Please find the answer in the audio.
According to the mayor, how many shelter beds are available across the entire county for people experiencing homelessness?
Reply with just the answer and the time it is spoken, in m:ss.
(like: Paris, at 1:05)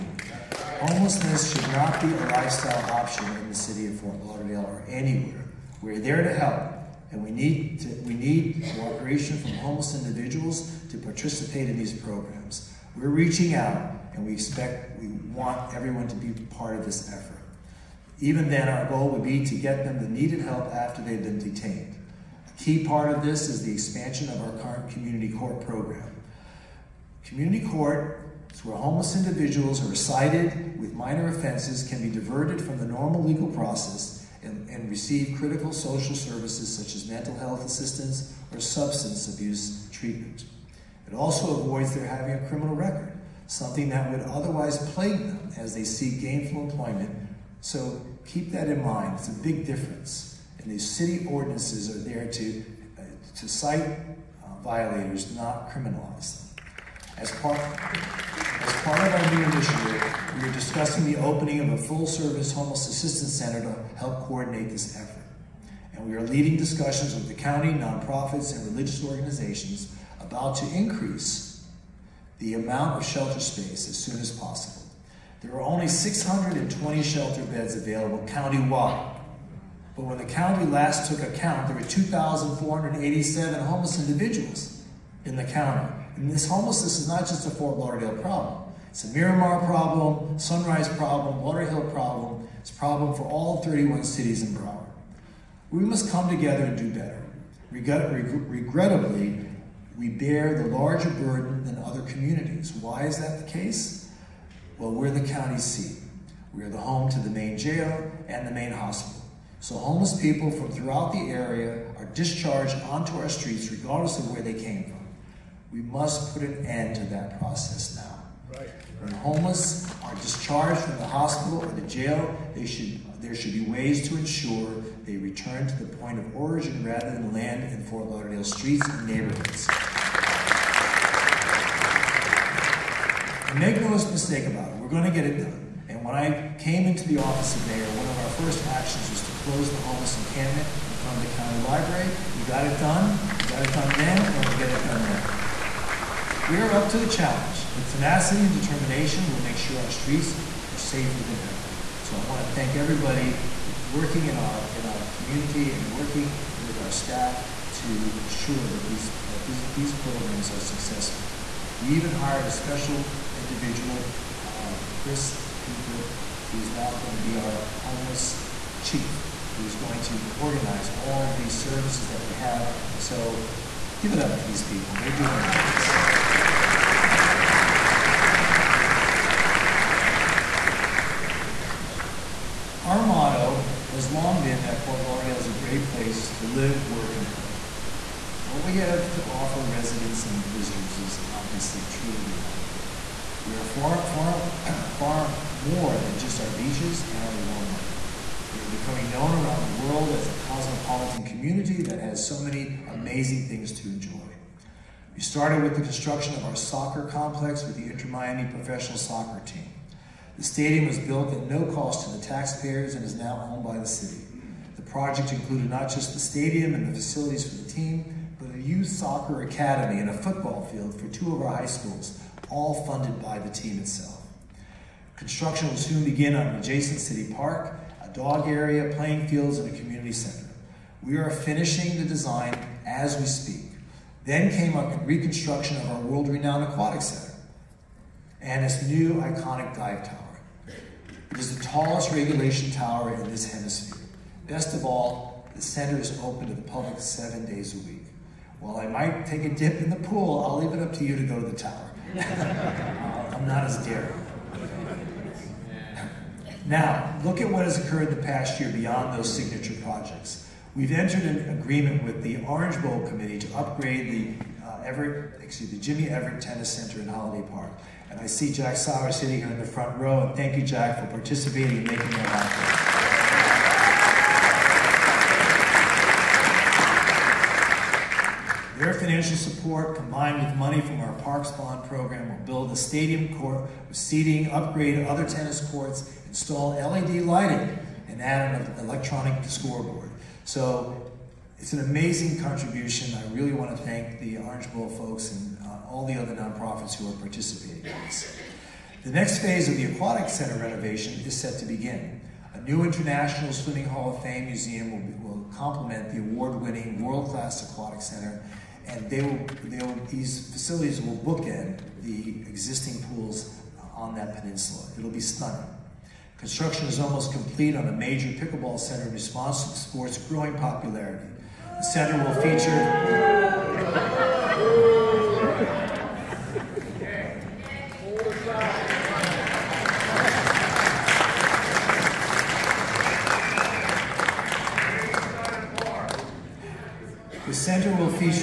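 620, at 1:15.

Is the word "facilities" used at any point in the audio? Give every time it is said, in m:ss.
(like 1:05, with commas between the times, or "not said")
3:36, 5:10.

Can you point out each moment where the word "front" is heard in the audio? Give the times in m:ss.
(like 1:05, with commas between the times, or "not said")
2:20, 4:29.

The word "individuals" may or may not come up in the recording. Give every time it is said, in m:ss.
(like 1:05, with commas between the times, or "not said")
0:10, 0:29, 1:24, 2:43.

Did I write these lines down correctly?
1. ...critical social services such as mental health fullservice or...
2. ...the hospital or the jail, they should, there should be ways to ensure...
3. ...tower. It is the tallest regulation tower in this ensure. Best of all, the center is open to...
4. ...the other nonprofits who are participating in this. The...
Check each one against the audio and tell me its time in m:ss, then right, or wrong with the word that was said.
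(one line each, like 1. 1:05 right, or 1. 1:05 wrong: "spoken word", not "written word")
1. 0:35 wrong: "assistance", not "fullservice"
2. 2:00 right
3. 4:00 wrong: "hemisphere", not "ensure"
4. 4:56 right.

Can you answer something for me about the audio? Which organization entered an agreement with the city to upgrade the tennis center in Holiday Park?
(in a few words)
Orange Bowl Committee.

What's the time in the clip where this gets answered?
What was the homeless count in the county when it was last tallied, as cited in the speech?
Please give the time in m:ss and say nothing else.
1:21.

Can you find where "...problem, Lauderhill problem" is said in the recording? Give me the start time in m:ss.
1:30.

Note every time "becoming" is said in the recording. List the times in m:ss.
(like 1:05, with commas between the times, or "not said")
3:18.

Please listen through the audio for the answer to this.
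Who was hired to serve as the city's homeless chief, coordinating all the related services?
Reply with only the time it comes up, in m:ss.
2:45.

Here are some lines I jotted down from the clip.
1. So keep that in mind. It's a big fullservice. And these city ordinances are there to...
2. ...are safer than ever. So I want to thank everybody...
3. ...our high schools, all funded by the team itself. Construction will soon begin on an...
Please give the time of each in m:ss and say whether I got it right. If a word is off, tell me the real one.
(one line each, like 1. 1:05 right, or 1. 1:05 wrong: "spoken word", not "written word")
1. 0:47 wrong: "difference", not "fullservice"
2. 2:30 right
3. 3:41 right.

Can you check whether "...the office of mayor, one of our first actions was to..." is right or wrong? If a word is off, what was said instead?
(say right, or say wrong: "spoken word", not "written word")
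right.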